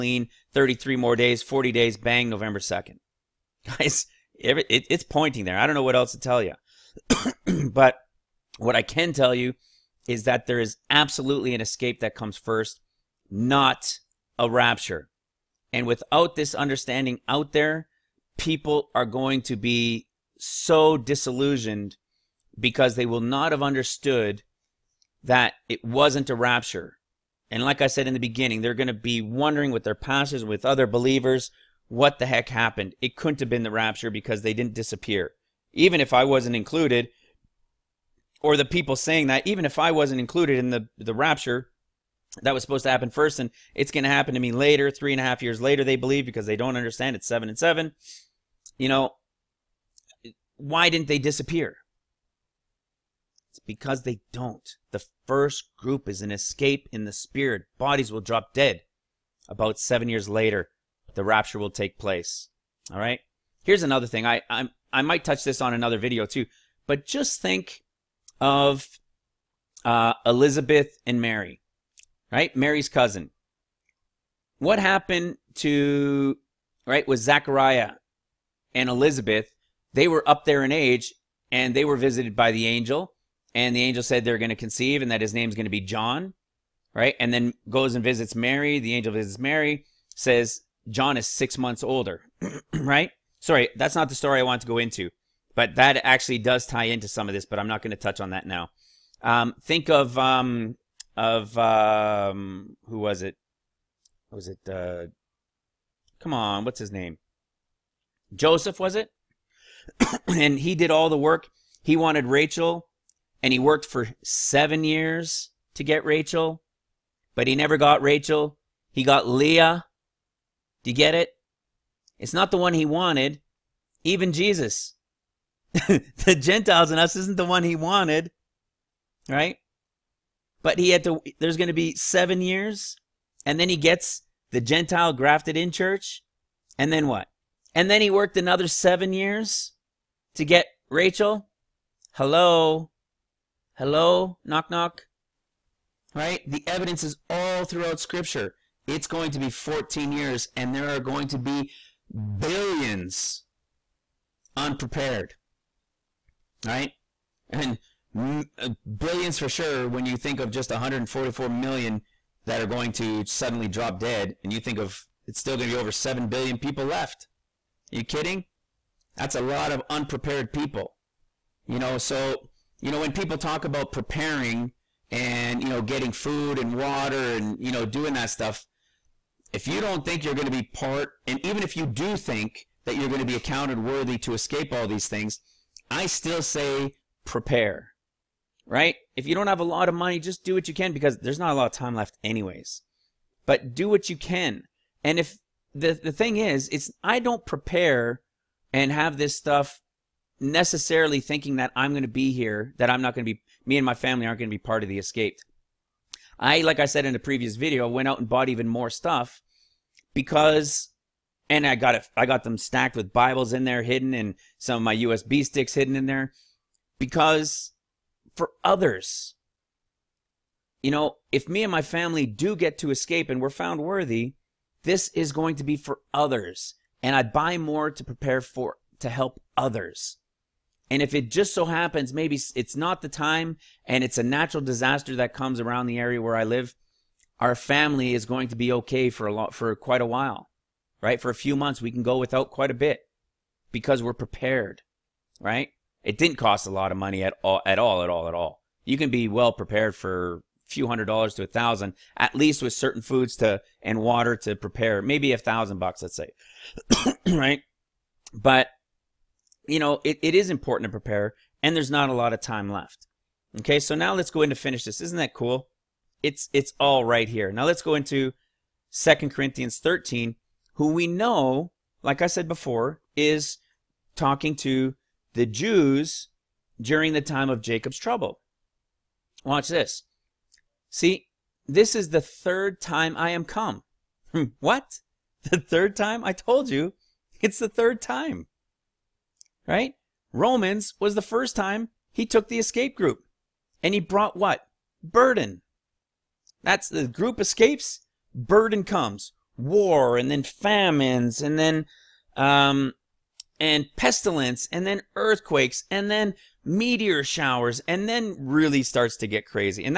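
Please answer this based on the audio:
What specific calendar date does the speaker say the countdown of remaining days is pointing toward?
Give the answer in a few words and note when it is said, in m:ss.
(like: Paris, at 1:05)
November 2, at 0:02.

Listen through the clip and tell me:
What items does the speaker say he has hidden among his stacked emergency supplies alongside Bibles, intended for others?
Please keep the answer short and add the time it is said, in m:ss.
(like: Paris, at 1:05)
USB sticks, at 3:34.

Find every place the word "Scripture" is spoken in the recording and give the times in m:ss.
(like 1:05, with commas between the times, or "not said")
2:27.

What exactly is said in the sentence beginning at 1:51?
He wanted Rachel, and he worked for seven years to get Rachel, but he never got Rachel.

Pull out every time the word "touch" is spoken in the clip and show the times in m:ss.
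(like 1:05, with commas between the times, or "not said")
1:05, 1:37.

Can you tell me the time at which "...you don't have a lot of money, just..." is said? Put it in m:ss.
3:09.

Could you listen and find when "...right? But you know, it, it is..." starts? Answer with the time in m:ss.
4:17.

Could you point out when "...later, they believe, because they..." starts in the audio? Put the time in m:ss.
0:45.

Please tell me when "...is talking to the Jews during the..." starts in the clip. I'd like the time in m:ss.
4:33.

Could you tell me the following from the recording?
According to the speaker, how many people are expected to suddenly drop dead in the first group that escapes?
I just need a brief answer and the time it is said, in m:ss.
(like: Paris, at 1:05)
144 million, at 2:40.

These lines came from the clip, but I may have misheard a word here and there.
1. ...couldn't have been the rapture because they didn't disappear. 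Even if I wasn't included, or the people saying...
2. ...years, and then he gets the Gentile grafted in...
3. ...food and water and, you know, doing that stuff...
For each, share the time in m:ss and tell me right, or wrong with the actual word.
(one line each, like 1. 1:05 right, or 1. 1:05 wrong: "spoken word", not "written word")
1. 0:33 right
2. 2:12 right
3. 2:56 right.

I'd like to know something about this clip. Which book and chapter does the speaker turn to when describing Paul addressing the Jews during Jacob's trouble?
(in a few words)
Second Corinthians 13.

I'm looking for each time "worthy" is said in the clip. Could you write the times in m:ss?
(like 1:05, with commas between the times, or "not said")
3:03, 3:43.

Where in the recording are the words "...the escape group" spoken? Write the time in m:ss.
4:52.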